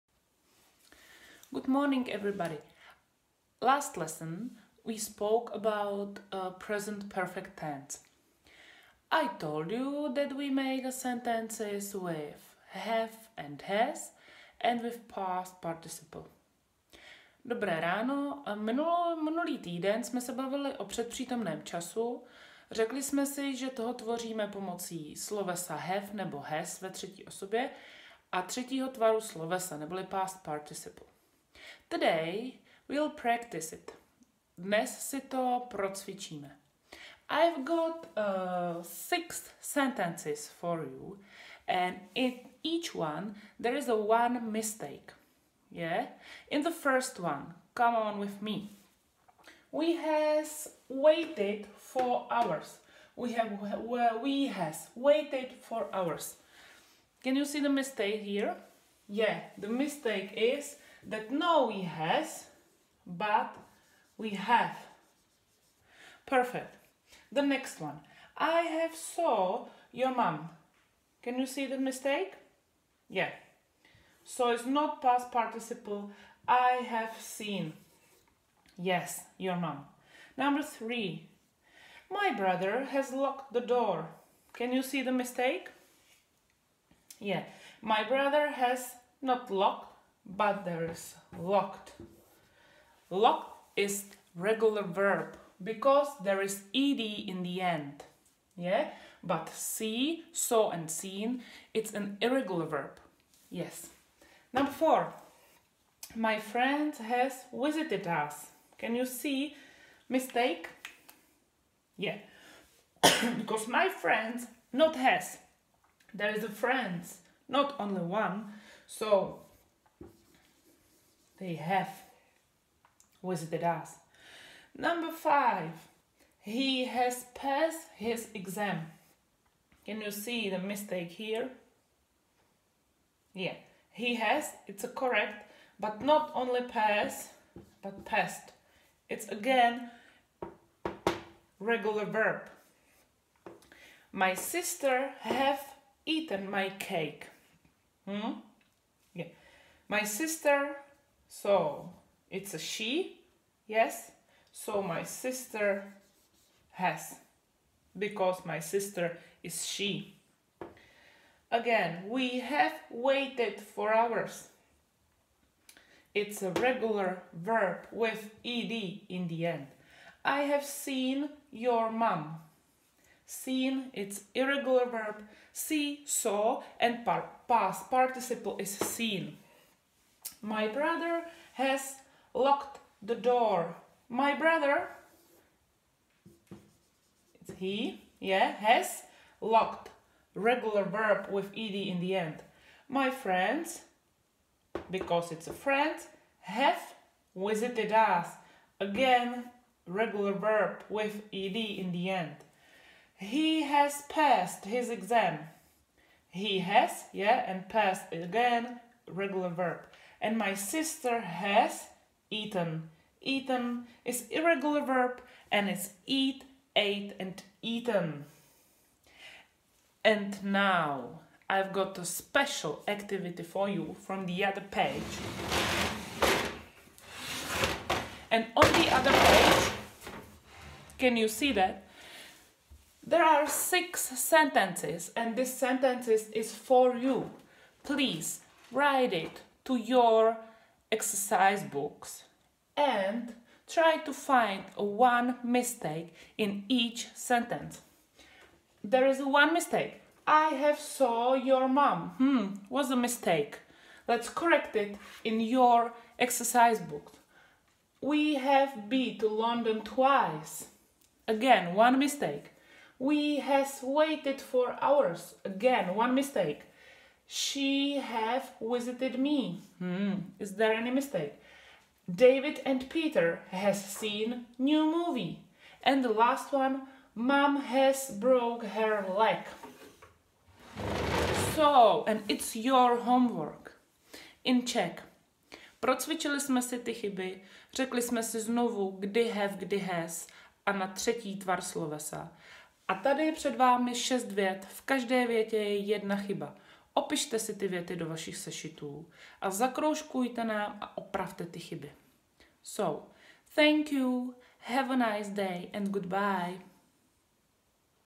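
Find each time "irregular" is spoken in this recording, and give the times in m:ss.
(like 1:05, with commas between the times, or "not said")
1:42, 2:54, 3:34.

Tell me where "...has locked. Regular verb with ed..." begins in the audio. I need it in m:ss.
3:08.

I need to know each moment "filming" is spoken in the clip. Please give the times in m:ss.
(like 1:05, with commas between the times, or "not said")
not said.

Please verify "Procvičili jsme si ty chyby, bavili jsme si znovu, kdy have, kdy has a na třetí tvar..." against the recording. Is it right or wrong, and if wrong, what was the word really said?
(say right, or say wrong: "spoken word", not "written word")
wrong: "řekli", not "bavili".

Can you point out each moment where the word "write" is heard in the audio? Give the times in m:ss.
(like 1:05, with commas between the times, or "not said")
3:58.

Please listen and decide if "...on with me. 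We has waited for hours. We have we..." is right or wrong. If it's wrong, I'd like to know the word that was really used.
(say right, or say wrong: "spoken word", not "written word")
right.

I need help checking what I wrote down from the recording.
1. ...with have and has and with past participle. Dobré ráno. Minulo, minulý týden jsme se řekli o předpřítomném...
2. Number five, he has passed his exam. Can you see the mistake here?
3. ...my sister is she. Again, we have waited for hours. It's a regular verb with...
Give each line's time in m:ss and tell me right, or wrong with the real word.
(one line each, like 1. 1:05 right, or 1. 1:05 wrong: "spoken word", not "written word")
1. 0:11 wrong: "bavili", not "řekli"
2. 2:04 right
3. 2:38 right.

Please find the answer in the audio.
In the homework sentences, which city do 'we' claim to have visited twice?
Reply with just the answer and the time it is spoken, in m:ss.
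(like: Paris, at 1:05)
London, at 4:19.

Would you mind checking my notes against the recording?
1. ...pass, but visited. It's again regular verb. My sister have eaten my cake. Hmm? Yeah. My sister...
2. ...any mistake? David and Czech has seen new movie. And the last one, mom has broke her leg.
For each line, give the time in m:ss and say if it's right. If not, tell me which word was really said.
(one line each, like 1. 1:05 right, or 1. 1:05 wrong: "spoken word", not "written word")
1. 2:16 wrong: "passed", not "visited"
2. 4:30 wrong: "Peter", not "Czech".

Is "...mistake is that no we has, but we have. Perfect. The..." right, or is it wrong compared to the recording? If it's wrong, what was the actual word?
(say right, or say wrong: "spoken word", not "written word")
right.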